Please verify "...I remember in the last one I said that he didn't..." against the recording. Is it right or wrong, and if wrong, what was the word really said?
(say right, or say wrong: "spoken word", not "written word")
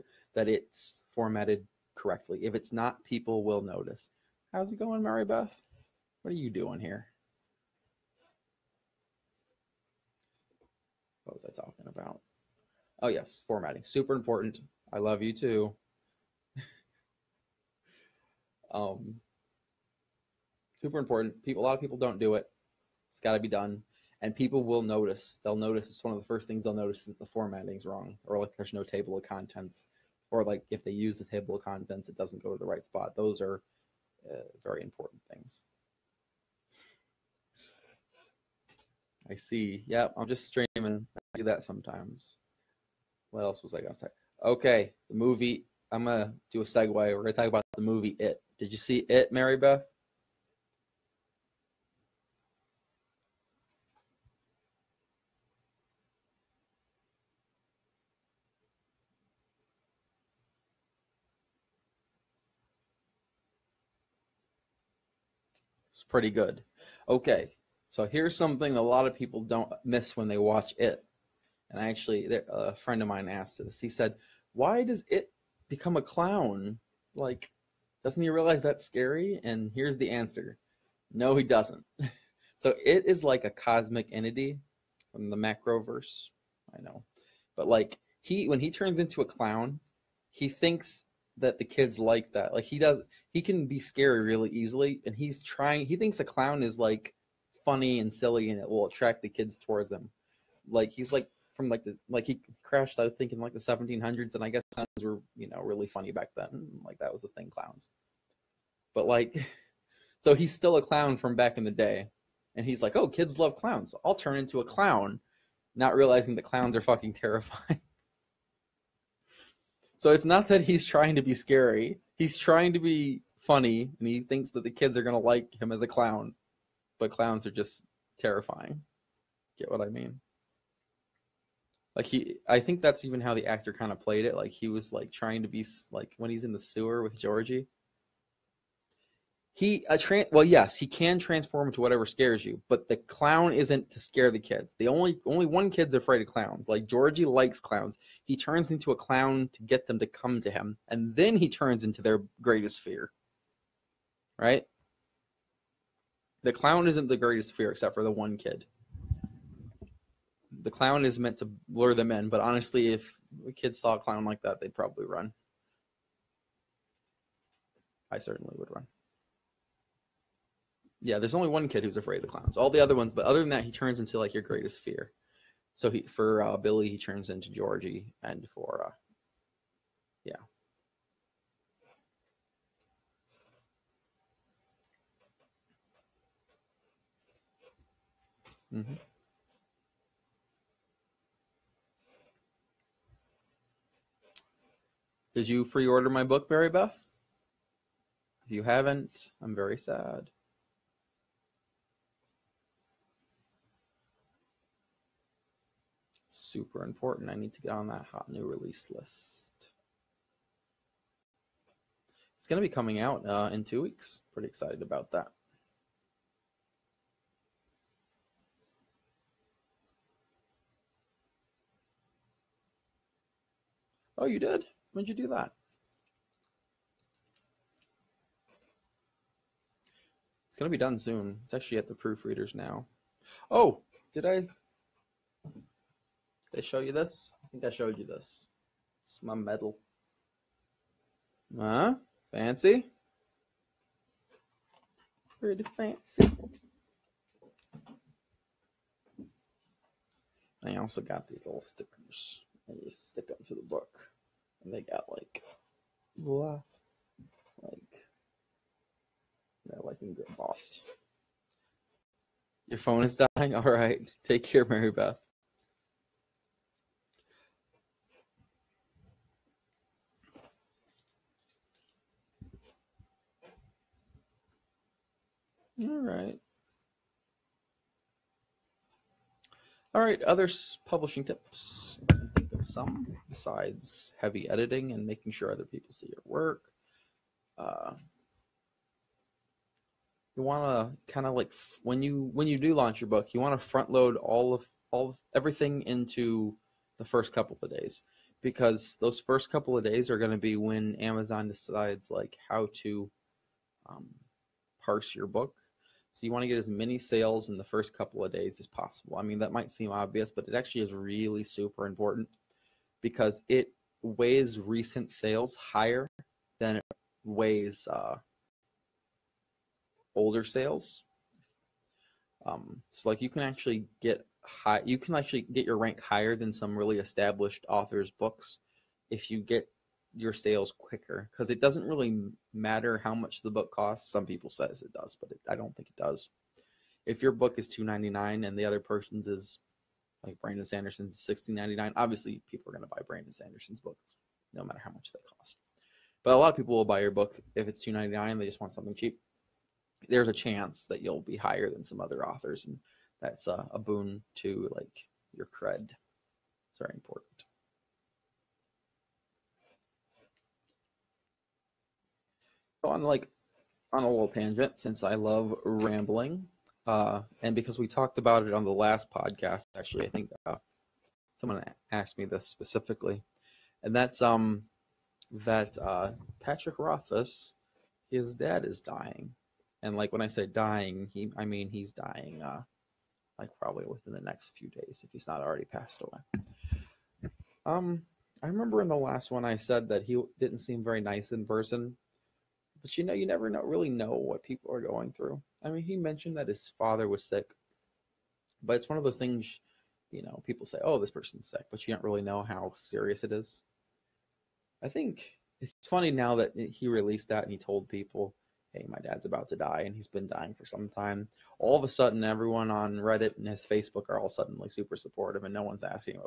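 right.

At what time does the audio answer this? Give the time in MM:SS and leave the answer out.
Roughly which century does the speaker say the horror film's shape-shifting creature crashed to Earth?
01:43.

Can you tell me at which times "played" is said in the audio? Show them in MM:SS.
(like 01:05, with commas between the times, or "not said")
02:13.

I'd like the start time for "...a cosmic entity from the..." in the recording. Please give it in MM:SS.
01:23.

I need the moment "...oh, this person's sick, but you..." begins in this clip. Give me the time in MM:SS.
06:40.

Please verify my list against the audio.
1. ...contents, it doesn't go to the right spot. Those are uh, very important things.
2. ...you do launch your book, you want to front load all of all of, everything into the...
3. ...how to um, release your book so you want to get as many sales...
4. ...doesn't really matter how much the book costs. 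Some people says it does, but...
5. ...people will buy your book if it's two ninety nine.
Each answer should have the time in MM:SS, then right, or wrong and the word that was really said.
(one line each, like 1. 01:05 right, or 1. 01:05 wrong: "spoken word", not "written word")
1. 00:31 right
2. 04:52 right
3. 05:02 wrong: "parse", not "release"
4. 05:31 right
5. 05:46 right.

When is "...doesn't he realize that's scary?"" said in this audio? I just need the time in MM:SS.
01:18.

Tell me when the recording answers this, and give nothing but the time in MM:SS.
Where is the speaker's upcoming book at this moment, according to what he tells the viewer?
03:51.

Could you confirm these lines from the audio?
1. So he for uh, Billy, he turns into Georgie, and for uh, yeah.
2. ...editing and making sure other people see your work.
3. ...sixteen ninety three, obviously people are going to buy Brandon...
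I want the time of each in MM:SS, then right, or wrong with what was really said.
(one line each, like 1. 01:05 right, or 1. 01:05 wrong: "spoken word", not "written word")
1. 02:55 right
2. 04:44 right
3. 05:41 wrong: "nine", not "three".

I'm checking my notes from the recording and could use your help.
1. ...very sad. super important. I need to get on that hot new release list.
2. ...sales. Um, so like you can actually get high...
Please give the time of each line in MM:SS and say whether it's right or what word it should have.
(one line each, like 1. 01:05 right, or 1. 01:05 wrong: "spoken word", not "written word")
1. 03:19 right
2. 05:20 right.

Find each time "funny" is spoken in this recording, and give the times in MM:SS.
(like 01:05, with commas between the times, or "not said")
01:37, 01:45, 02:03, 06:45.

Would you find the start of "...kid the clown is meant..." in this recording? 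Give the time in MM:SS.
02:38.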